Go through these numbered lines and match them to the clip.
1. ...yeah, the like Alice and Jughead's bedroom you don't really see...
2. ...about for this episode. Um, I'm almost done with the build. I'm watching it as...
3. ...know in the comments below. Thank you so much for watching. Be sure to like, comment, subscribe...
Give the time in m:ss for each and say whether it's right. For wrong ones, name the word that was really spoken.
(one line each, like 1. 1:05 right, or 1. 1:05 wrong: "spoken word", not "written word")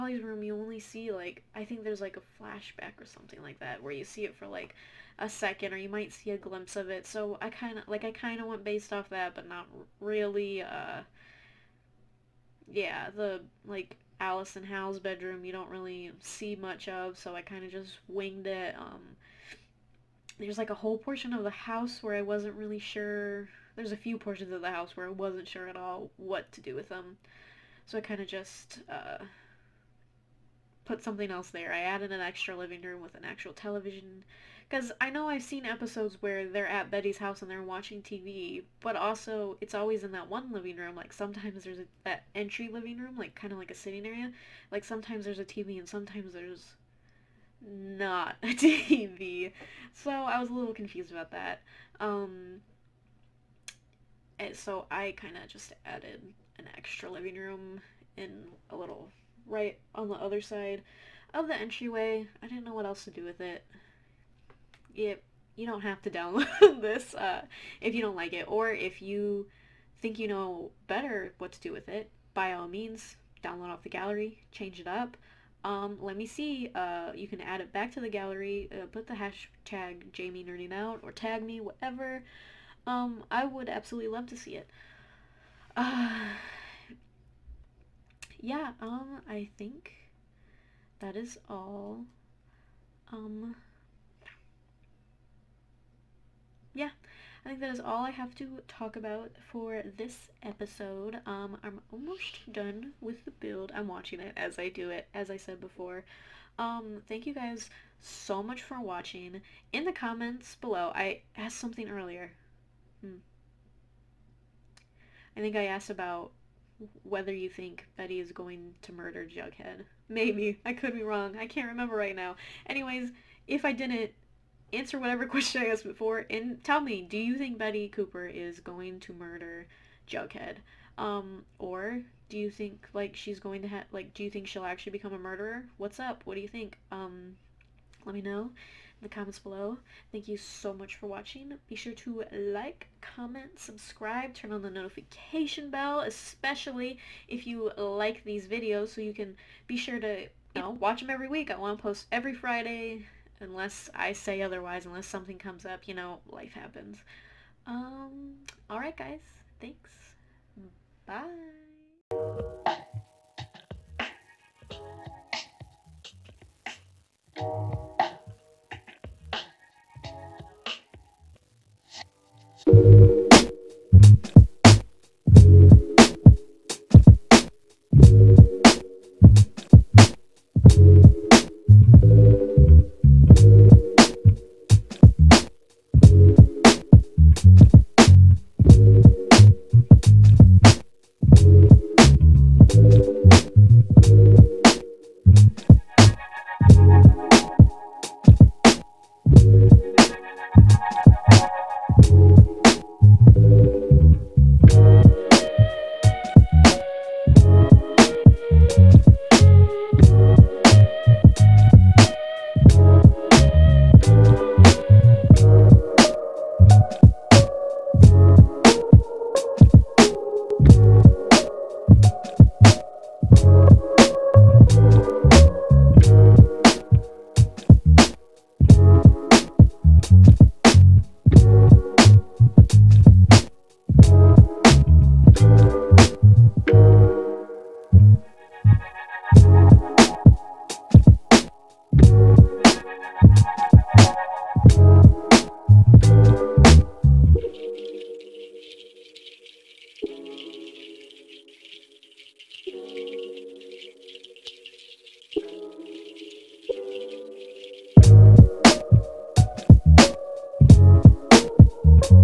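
1. 0:12 wrong: "Hal", not "Jughead"
2. 1:38 right
3. 2:18 right.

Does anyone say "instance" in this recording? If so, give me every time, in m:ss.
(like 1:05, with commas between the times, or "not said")
not said.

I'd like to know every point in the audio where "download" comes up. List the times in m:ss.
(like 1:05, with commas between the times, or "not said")
1:06, 1:13.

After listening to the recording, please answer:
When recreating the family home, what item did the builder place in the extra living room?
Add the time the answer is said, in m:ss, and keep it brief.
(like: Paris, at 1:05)
television, at 0:33.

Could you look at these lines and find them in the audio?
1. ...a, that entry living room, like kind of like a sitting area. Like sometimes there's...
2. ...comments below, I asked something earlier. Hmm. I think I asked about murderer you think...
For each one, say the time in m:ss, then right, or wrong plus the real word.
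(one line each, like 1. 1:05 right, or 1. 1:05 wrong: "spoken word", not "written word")
1. 0:41 right
2. 1:49 wrong: "whether", not "murderer".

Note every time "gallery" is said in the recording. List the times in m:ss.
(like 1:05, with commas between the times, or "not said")
1:13, 1:18.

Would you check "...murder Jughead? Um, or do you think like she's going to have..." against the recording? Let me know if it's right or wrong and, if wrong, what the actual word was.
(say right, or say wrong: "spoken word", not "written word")
right.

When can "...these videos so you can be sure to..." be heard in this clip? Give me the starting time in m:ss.
2:28.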